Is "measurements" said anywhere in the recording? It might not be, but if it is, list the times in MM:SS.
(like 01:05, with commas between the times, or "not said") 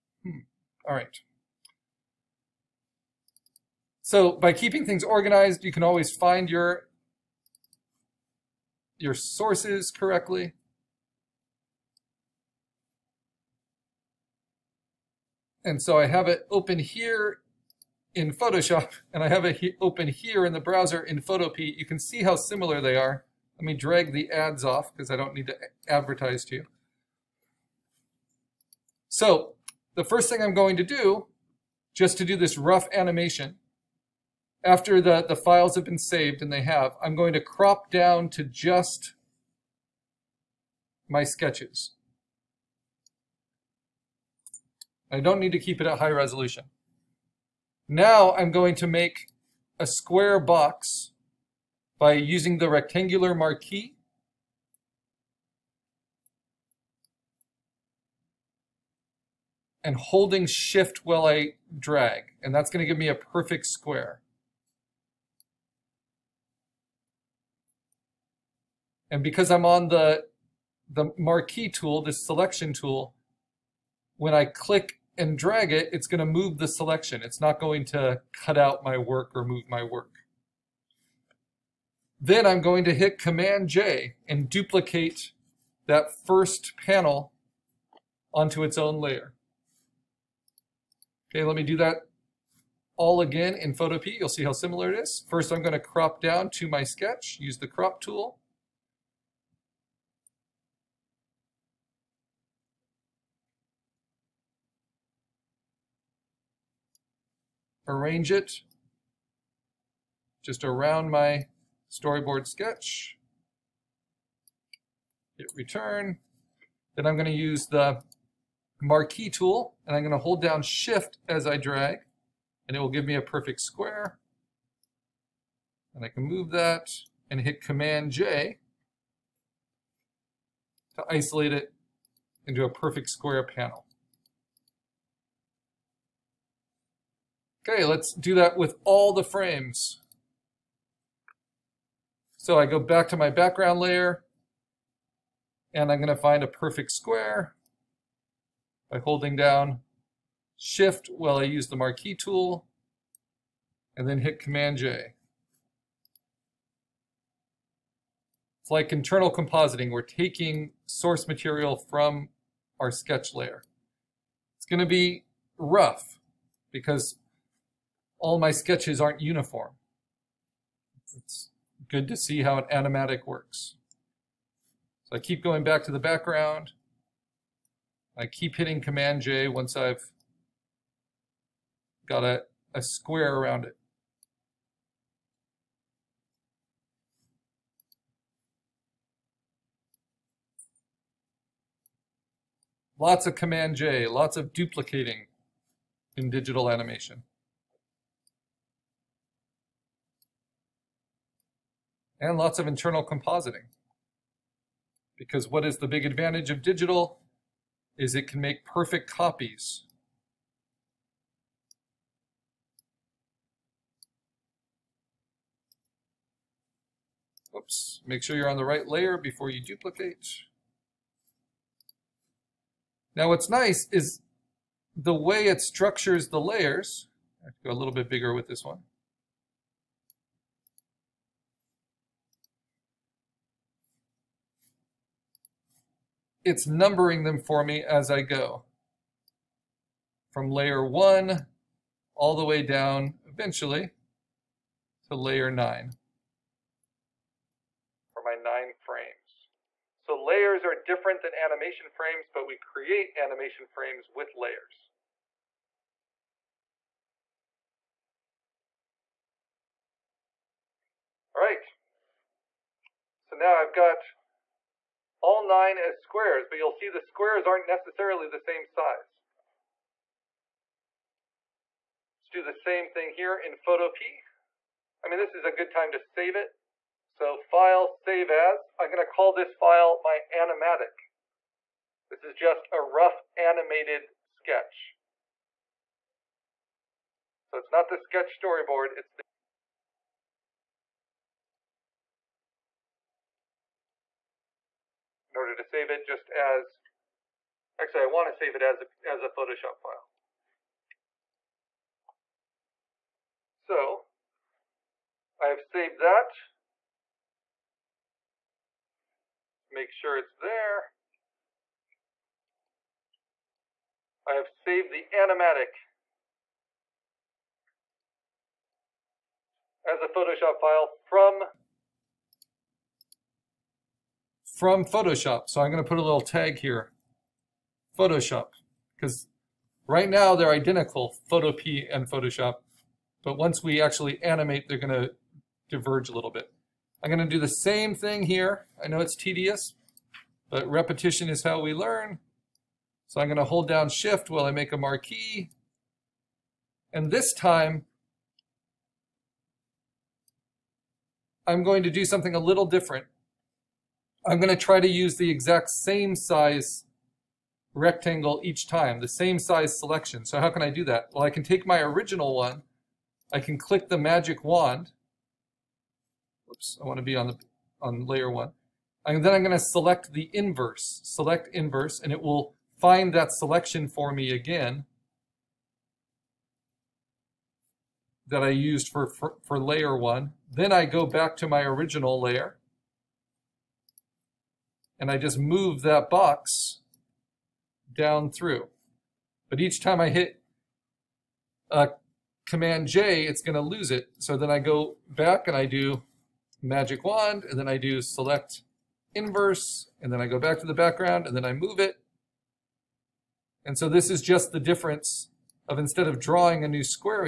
not said.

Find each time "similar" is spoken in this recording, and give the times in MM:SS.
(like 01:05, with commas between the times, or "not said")
00:22, 01:34.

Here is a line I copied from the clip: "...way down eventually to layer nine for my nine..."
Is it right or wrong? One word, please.
right.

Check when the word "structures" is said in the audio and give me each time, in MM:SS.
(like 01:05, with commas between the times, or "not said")
03:45.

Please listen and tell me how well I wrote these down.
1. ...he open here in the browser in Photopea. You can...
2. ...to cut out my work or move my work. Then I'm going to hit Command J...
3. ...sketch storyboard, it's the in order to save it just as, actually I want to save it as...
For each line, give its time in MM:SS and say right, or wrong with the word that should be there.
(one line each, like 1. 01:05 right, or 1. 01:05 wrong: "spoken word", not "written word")
1. 00:19 right
2. 01:17 right
3. 04:47 right.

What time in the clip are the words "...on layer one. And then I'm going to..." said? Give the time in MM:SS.
06:07.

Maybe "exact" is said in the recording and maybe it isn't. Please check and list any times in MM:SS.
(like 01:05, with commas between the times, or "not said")
05:55.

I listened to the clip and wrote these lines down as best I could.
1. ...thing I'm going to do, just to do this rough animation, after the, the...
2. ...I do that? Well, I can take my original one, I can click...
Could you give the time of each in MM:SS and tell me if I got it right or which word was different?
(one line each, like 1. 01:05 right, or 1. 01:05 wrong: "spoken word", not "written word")
1. 00:30 right
2. 06:00 right.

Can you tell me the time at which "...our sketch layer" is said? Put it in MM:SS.
02:42.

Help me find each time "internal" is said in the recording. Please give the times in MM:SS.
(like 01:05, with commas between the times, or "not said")
02:38, 03:22.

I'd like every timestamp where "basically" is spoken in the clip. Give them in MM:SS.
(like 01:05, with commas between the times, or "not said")
not said.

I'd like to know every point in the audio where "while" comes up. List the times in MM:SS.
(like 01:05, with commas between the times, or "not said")
01:01, 02:31, 05:44.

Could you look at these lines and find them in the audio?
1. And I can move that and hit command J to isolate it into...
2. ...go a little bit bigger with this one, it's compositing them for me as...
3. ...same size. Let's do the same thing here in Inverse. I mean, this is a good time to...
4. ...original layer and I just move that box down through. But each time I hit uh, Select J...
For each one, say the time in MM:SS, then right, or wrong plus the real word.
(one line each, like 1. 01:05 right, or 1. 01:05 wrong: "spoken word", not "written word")
1. 02:05 right
2. 03:47 wrong: "numbering", not "compositing"
3. 04:28 wrong: "Photopea", not "Inverse"
4. 06:21 wrong: "Command", not "Select".